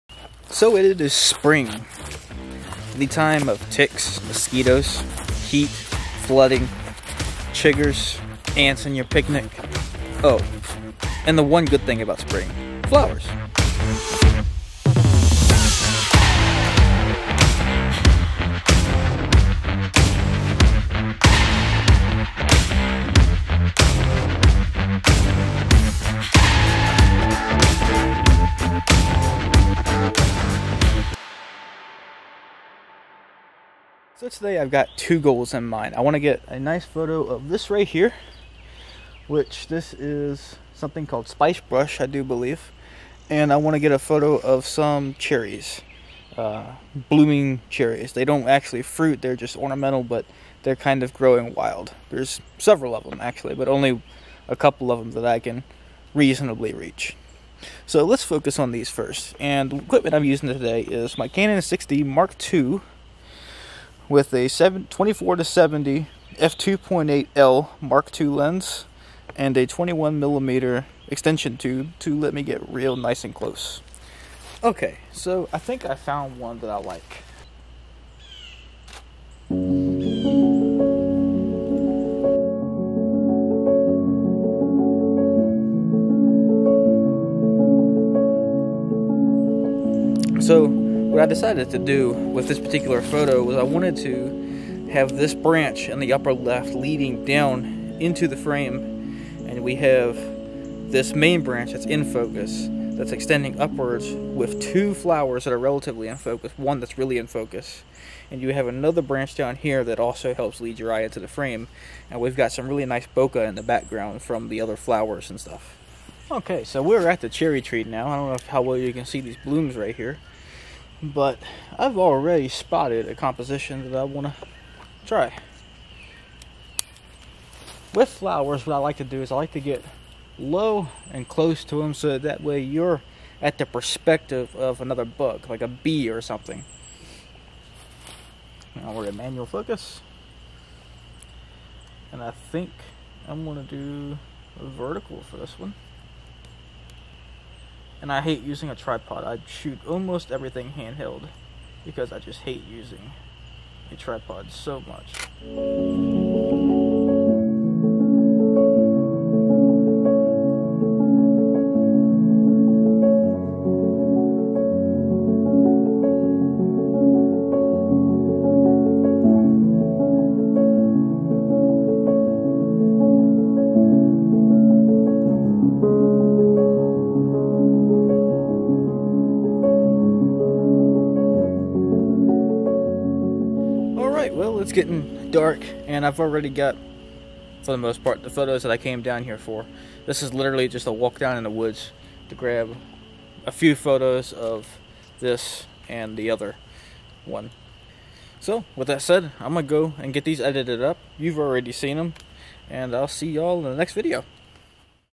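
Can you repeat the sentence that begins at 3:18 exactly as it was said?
So, with that said, I'm going to go and get these edited up.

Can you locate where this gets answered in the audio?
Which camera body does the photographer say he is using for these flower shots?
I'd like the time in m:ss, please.
1:01.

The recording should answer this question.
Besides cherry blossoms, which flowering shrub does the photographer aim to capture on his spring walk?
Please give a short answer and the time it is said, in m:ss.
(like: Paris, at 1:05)
spicebush, at 0:41.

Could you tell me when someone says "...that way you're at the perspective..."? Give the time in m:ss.
2:12.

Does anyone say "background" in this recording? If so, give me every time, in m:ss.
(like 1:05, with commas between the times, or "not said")
1:53.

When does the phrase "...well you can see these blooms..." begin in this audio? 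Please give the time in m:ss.
1:58.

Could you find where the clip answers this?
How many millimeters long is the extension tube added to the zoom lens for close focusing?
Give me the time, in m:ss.
1:09.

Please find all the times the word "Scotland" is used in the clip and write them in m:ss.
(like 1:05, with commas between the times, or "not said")
not said.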